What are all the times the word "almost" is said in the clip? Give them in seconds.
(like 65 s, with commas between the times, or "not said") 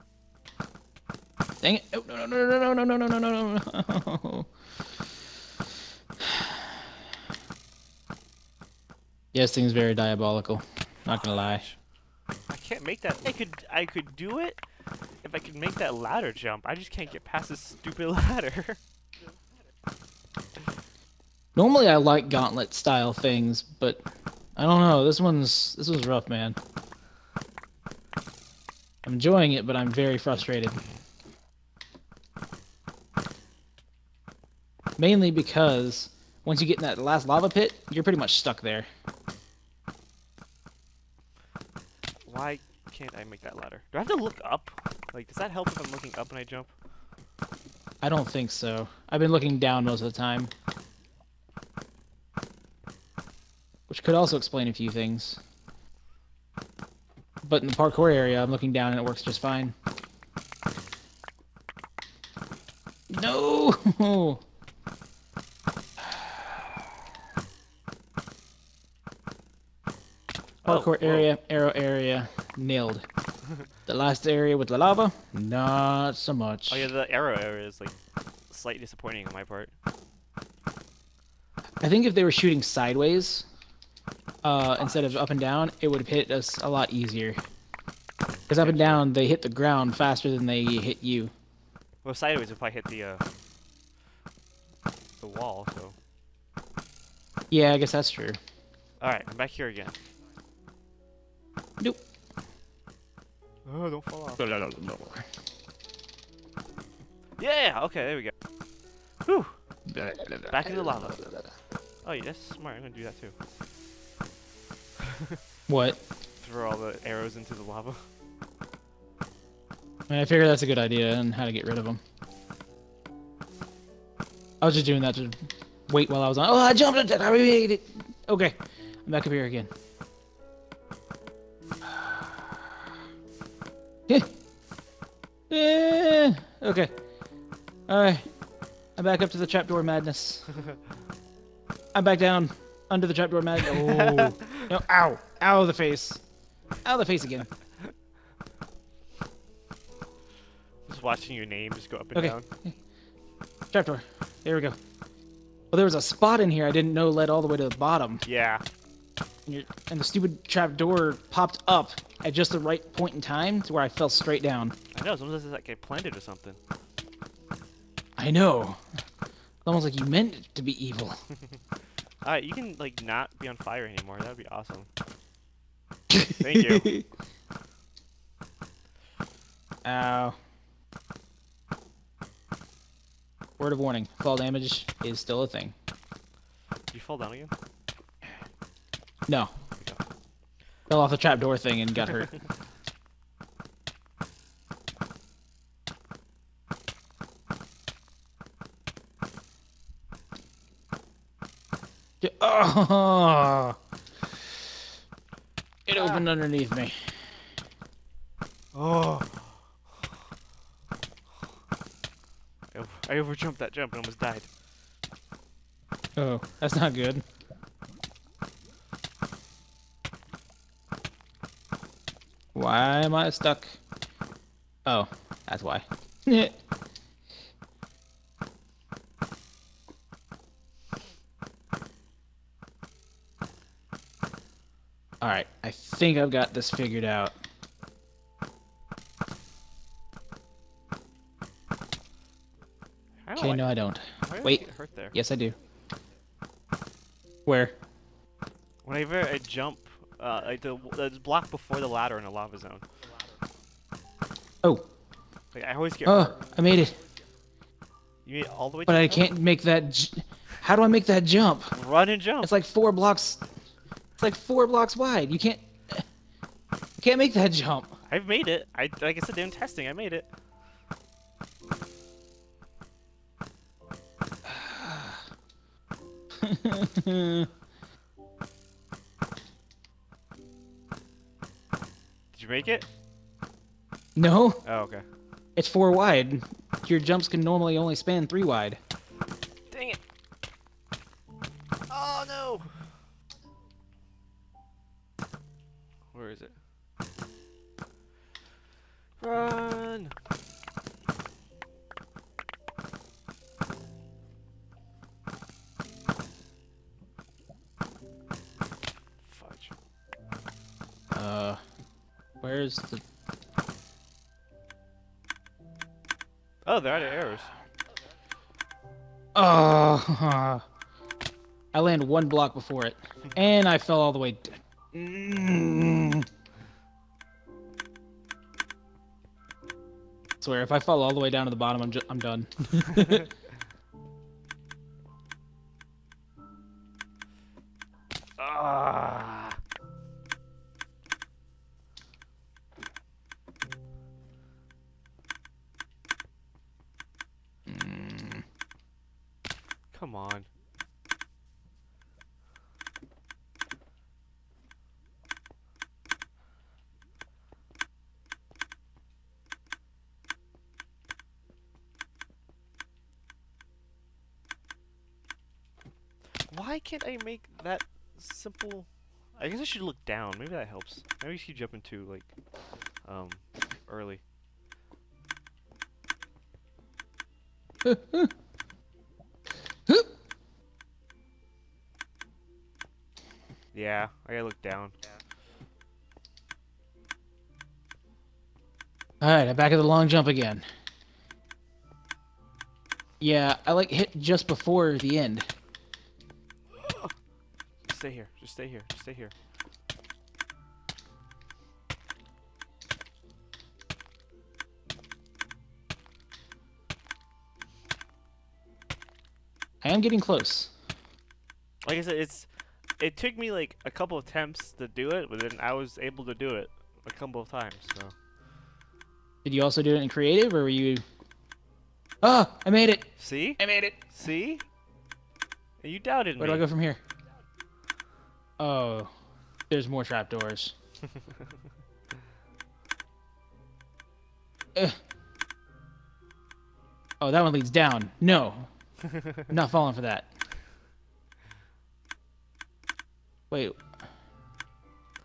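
165 s, 169 s, 214 s.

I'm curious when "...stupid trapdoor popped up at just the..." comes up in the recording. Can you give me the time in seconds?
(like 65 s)
160 s.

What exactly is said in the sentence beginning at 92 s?
Well, sideways if I hit the, uh, the wall, so...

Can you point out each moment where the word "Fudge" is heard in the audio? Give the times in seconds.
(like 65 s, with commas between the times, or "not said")
309 s.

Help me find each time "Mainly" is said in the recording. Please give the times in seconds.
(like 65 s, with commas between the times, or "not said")
34 s.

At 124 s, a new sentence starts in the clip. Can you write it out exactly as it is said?
I was just doing that to wait while I was on.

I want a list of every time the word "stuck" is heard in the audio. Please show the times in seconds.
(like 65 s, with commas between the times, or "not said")
38 s, 223 s.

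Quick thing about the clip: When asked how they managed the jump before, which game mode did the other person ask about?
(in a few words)
Creative.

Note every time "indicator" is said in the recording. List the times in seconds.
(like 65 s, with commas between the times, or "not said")
not said.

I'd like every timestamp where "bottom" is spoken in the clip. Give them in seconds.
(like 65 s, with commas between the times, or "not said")
157 s, 331 s.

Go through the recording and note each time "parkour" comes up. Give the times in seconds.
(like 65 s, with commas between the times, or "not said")
57 s, 70 s.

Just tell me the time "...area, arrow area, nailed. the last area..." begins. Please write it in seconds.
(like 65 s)
71 s.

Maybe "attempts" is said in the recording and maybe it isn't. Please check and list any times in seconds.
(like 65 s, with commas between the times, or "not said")
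414 s.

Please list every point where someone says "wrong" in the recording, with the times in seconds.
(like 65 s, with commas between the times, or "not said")
not said.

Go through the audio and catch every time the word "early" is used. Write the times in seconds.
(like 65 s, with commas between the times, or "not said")
373 s.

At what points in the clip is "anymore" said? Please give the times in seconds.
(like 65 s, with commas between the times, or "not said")
173 s.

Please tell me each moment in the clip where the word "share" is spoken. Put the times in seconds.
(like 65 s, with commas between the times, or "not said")
not said.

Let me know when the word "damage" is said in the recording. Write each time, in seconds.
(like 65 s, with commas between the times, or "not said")
184 s.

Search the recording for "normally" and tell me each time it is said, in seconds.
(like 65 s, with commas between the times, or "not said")
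21 s, 287 s.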